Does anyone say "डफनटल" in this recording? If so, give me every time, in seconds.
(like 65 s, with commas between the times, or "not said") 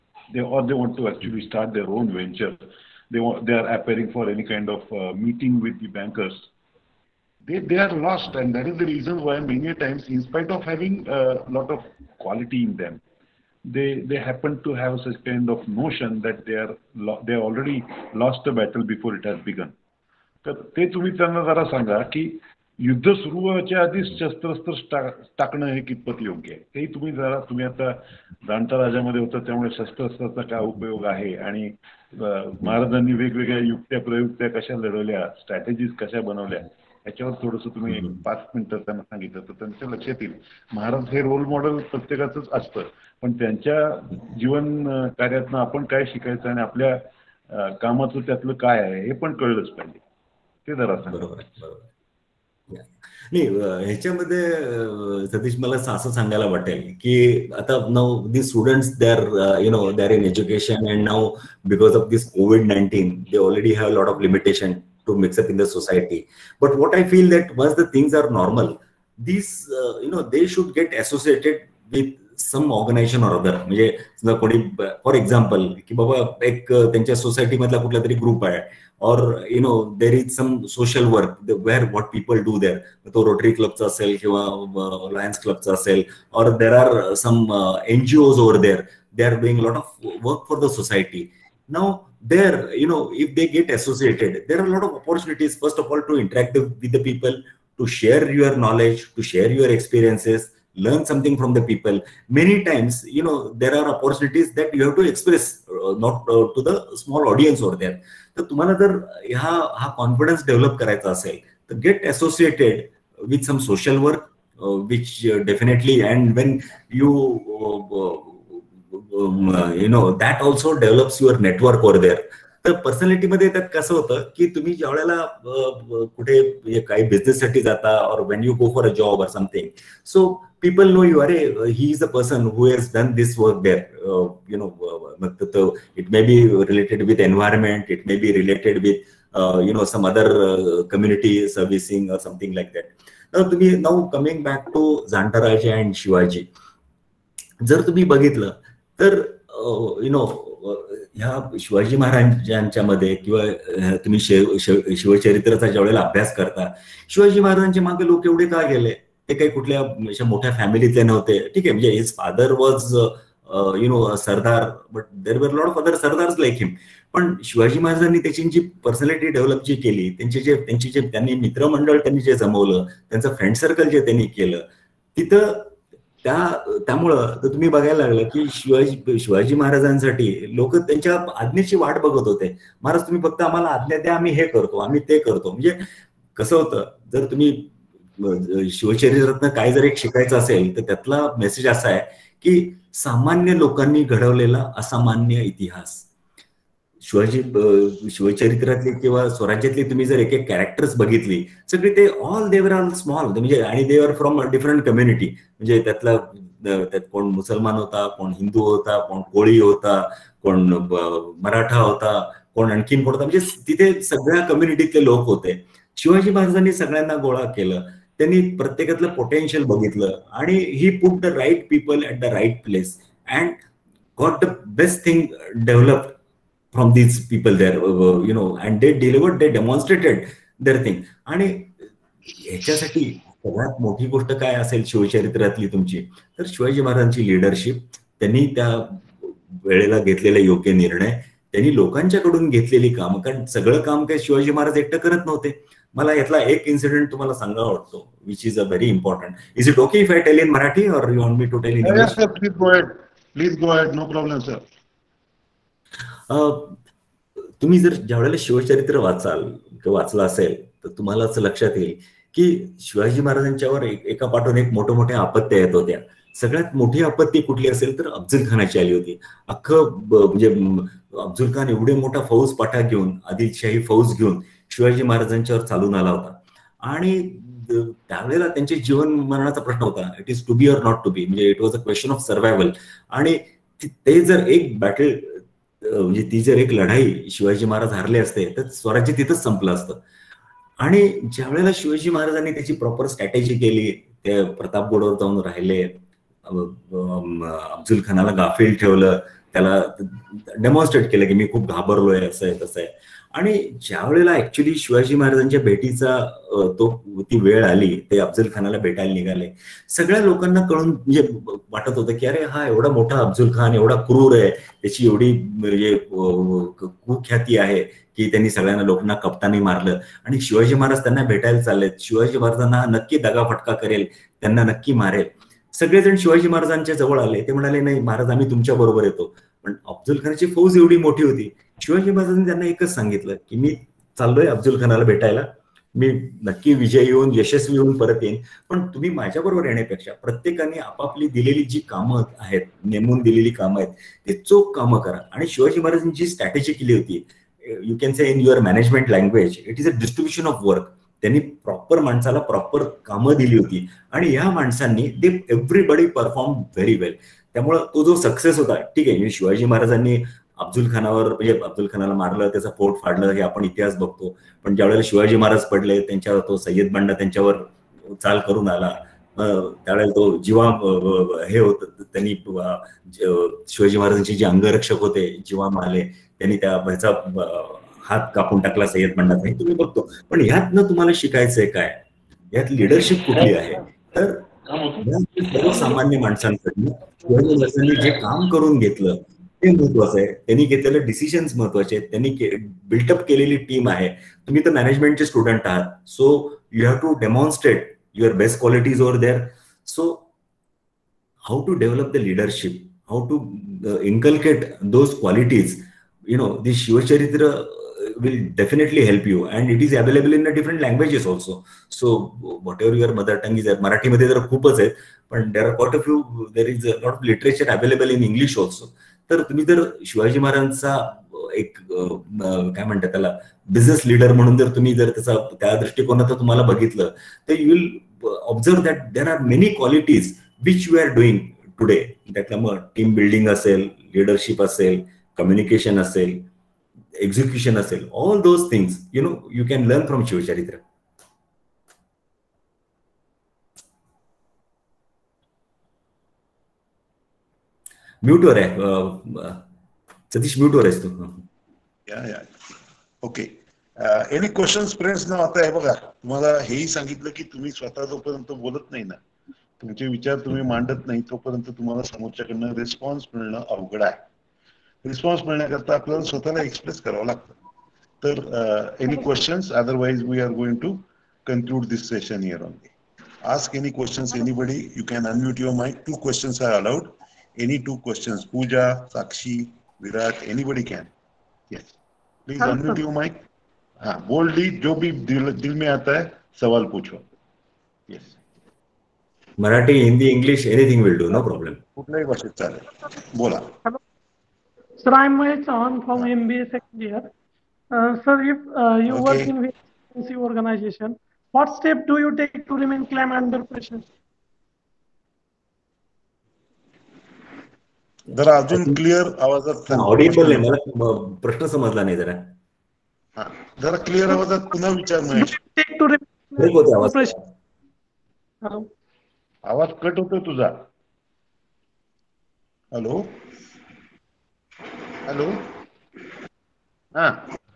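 115 s, 408 s.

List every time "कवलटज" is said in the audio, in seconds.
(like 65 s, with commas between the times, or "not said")
398 s, 405 s, 429 s.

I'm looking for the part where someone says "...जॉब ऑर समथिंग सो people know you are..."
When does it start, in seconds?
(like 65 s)
128 s.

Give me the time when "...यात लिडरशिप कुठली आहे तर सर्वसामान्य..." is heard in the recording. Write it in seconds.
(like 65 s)
382 s.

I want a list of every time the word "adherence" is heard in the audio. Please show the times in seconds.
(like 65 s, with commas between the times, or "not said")
not said.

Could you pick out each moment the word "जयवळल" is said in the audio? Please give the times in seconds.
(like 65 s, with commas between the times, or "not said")
155 s, 364 s.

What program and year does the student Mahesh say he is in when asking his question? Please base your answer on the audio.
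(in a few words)
MBA second year.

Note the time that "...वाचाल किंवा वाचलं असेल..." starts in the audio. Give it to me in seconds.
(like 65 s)
258 s.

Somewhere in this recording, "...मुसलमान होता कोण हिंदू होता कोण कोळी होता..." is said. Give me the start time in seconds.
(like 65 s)
207 s.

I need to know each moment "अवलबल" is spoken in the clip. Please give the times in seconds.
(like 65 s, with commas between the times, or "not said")
409 s, 417 s.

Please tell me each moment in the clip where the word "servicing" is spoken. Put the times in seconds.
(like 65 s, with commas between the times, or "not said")
141 s.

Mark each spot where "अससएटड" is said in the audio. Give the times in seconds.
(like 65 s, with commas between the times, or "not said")
70 s, 112 s.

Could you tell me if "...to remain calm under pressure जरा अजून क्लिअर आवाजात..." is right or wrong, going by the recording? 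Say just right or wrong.
right.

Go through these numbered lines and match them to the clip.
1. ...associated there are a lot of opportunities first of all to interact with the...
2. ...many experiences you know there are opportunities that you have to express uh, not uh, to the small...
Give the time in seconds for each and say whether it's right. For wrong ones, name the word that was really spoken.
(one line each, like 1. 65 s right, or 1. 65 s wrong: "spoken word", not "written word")
1. 93 s right
2. 102 s wrong: "times", not "experiences".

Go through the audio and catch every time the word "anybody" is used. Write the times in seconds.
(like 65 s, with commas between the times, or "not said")
480 s.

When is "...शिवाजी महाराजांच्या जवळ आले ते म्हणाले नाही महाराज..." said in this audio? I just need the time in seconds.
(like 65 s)
326 s.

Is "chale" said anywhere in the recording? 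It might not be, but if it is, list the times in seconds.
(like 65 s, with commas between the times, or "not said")
492 s.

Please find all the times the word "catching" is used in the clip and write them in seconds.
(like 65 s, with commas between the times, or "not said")
not said.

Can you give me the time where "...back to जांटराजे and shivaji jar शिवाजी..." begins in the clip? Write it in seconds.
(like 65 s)
144 s.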